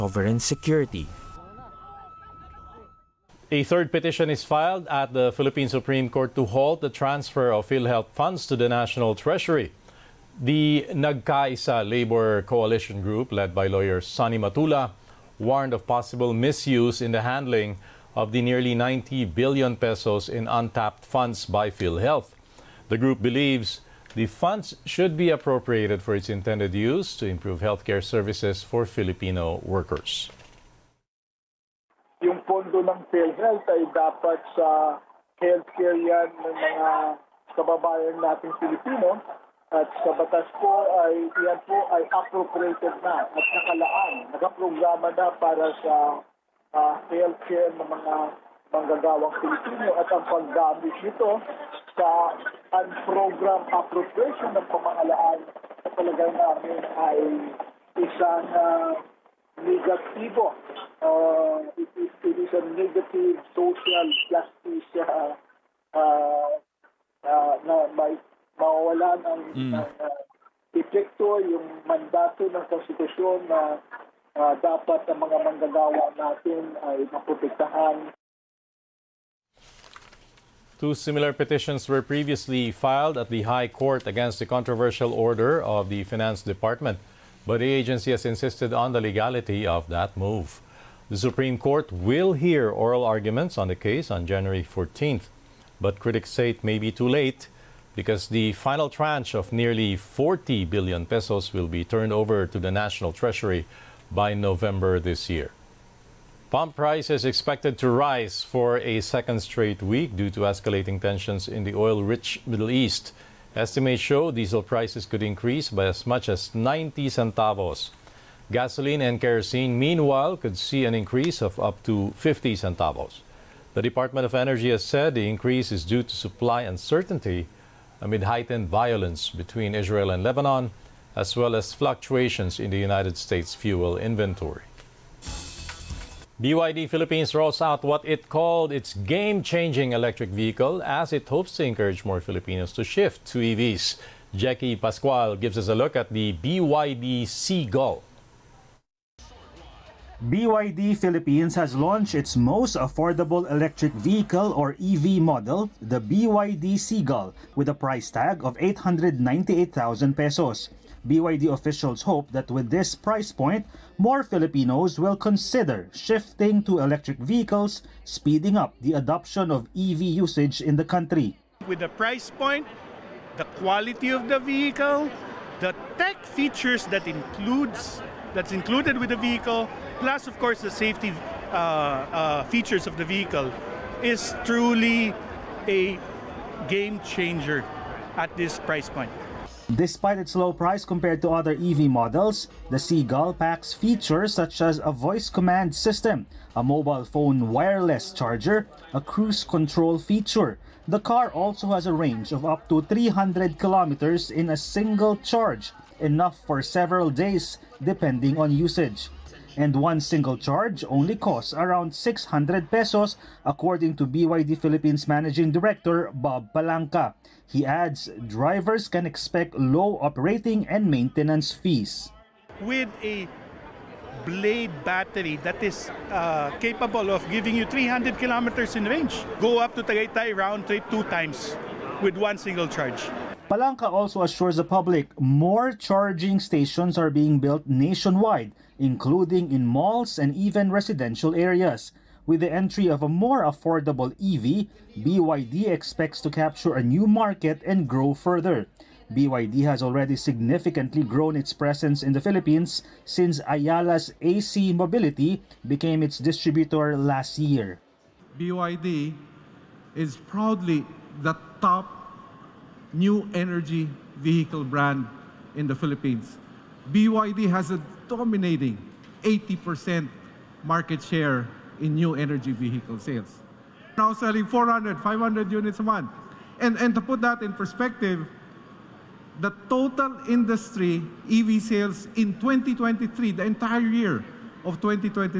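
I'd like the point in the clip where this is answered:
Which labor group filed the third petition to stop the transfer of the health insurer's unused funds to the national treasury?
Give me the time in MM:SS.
00:10.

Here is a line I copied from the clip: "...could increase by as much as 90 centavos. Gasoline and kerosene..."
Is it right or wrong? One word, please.
right.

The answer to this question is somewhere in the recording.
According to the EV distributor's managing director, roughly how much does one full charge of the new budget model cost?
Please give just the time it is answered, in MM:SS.
03:31.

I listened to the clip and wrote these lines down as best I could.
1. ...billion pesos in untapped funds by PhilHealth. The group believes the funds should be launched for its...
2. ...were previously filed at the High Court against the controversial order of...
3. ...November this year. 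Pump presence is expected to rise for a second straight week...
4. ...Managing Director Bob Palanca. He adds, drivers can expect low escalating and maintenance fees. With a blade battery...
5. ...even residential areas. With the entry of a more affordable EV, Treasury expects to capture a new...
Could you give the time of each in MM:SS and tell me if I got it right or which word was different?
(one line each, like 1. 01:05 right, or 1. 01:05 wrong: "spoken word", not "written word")
1. 00:19 wrong: "appropriated", not "launched"
2. 01:21 right
3. 01:44 wrong: "price", not "presence"
4. 03:35 wrong: "operating", not "escalating"
5. 04:00 wrong: "BYD", not "Treasury".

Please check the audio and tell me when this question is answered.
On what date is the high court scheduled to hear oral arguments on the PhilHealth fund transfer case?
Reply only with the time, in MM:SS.
01:34.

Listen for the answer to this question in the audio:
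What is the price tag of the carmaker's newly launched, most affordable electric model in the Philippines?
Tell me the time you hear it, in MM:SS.
02:38.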